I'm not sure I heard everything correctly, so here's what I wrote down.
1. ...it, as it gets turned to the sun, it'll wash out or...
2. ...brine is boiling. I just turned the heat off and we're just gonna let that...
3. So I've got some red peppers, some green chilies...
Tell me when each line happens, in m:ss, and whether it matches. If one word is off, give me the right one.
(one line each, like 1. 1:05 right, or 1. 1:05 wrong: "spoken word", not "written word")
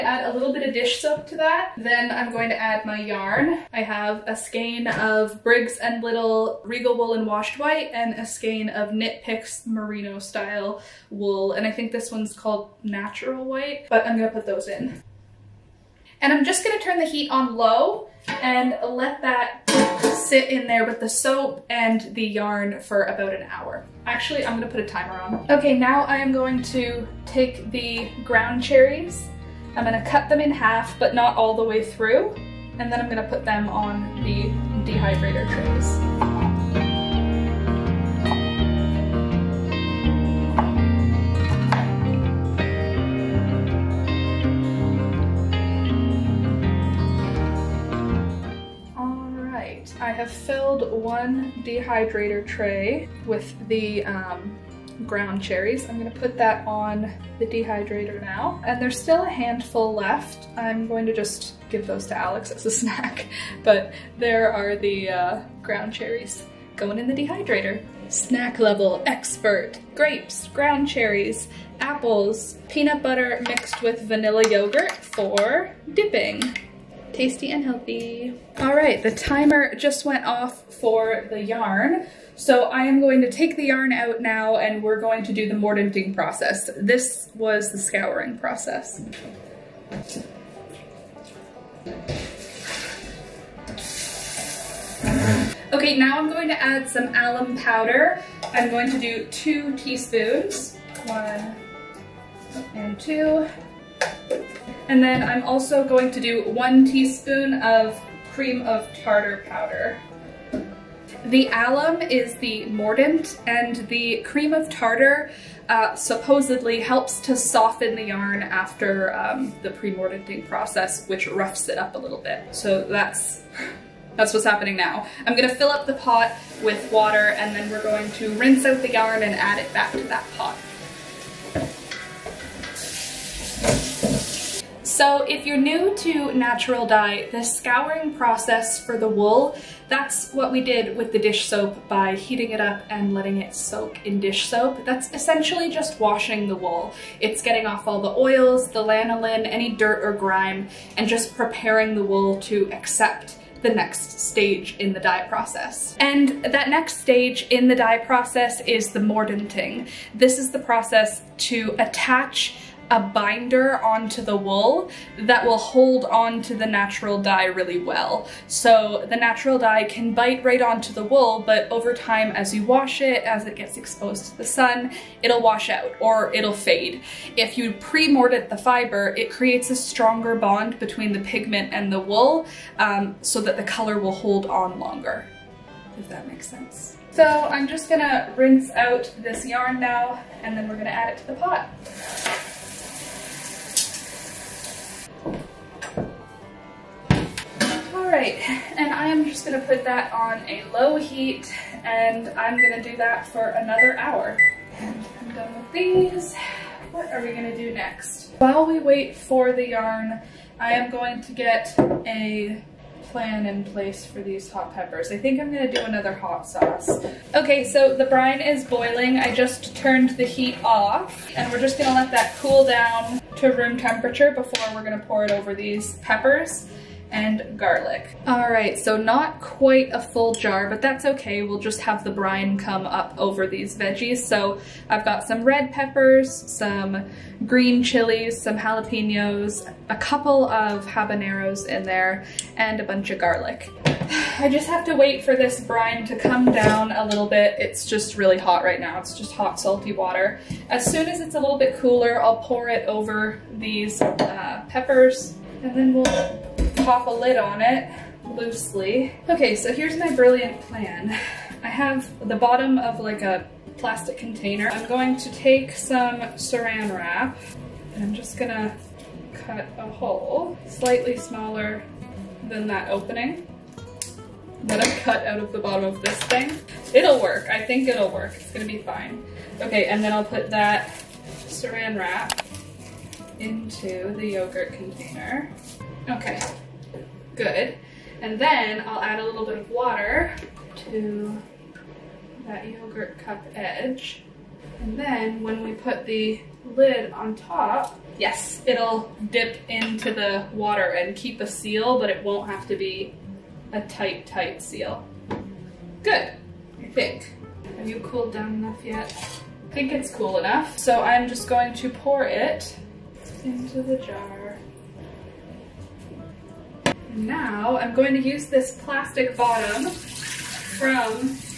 1. 2:52 wrong: "exposed", not "turned"
2. 3:38 right
3. 3:54 right.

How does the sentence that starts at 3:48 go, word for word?
All right, so not quite a full jar, but that's okay.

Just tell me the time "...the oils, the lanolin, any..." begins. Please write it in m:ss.
2:28.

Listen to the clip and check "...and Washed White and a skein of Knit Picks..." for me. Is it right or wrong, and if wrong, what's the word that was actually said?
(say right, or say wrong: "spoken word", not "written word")
right.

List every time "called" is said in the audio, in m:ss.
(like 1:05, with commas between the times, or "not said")
0:12.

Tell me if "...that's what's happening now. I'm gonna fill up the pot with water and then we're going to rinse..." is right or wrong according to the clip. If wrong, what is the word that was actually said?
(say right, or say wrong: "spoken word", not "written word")
right.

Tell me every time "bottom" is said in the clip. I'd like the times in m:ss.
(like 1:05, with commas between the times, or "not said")
4:22, 4:35, 5:19.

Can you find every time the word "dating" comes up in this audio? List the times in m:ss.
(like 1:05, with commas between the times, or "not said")
not said.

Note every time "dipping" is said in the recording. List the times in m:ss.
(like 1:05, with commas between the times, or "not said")
1:15.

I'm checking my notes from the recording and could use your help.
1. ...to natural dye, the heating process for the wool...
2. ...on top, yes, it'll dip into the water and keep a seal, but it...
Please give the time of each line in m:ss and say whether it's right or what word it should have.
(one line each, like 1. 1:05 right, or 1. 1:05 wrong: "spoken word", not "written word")
1. 2:15 wrong: "scouring", not "heating"
2. 4:57 right.